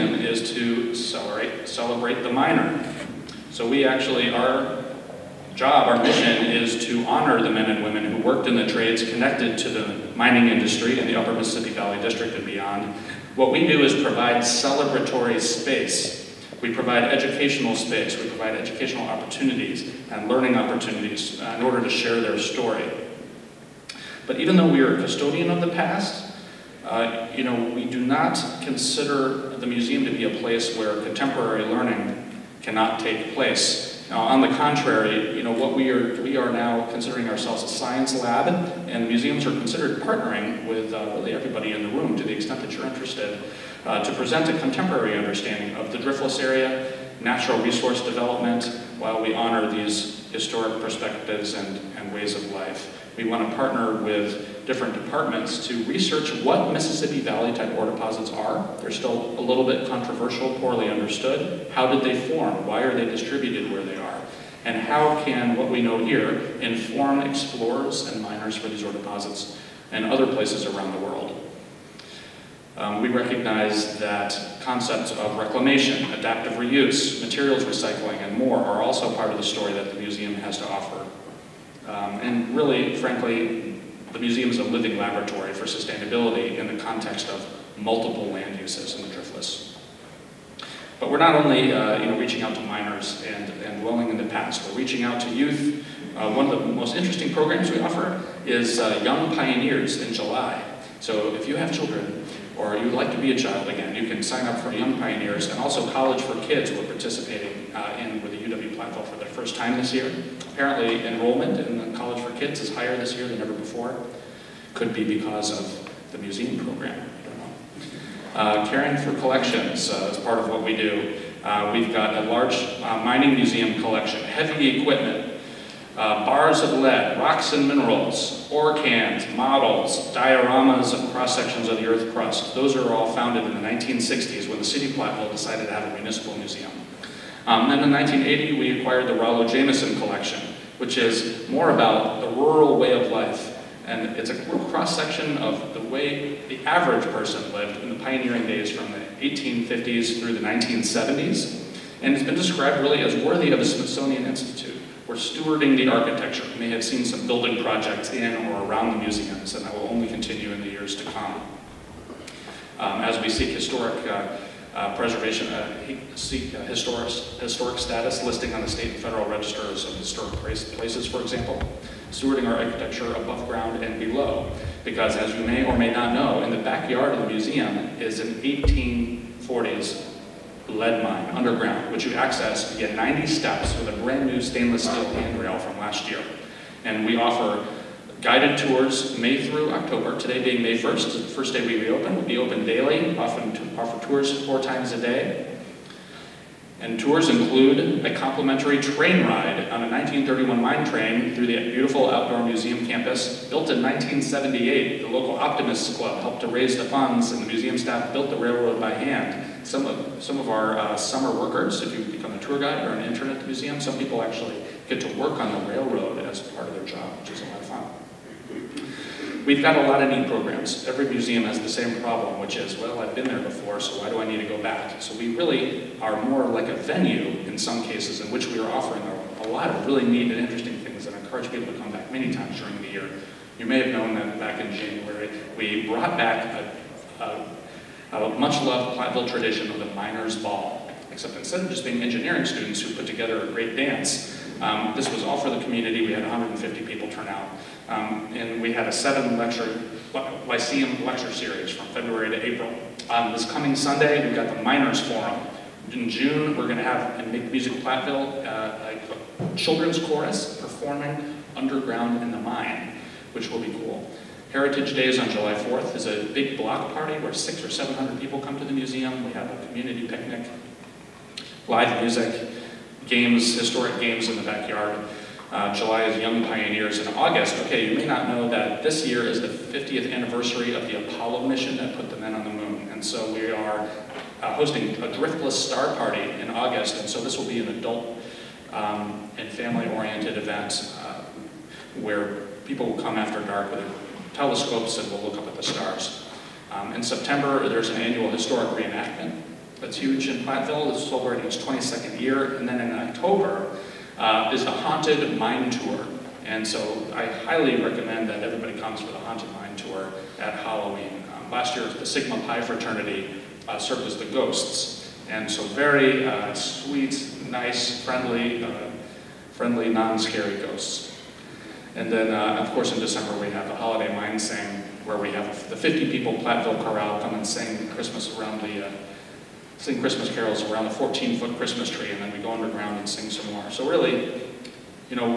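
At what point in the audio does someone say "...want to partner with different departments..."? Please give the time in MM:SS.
00:53.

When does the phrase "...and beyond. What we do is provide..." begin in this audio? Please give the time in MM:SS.
00:12.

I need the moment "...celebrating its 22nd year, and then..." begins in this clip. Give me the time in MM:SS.
05:01.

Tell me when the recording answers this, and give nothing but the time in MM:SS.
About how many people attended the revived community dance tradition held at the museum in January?
04:06.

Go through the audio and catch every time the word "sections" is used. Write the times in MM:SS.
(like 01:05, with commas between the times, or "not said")
02:11, 02:24.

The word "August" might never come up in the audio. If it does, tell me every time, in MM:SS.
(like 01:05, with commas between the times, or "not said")
04:37, 04:46.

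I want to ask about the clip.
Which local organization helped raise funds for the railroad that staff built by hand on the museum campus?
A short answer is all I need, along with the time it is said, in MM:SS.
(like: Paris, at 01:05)
Optimists Club, at 03:25.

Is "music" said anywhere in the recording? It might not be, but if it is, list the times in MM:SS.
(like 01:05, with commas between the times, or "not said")
04:17, 04:32.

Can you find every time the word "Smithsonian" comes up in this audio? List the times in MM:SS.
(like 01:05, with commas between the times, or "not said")
02:33.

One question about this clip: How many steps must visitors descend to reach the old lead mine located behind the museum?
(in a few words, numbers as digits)
90.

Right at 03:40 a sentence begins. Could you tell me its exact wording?
Every museum has the same problem, which is, well, I've been there before, so why do I need to go back?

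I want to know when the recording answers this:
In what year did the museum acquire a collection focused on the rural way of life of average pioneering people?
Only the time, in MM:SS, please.
02:17.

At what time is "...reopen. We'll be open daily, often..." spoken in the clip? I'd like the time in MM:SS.
03:11.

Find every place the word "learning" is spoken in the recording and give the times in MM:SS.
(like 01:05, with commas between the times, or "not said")
00:20, 00:31.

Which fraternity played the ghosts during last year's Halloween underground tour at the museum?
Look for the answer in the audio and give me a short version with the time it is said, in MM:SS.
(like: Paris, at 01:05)
Sigma Pi, at 05:12.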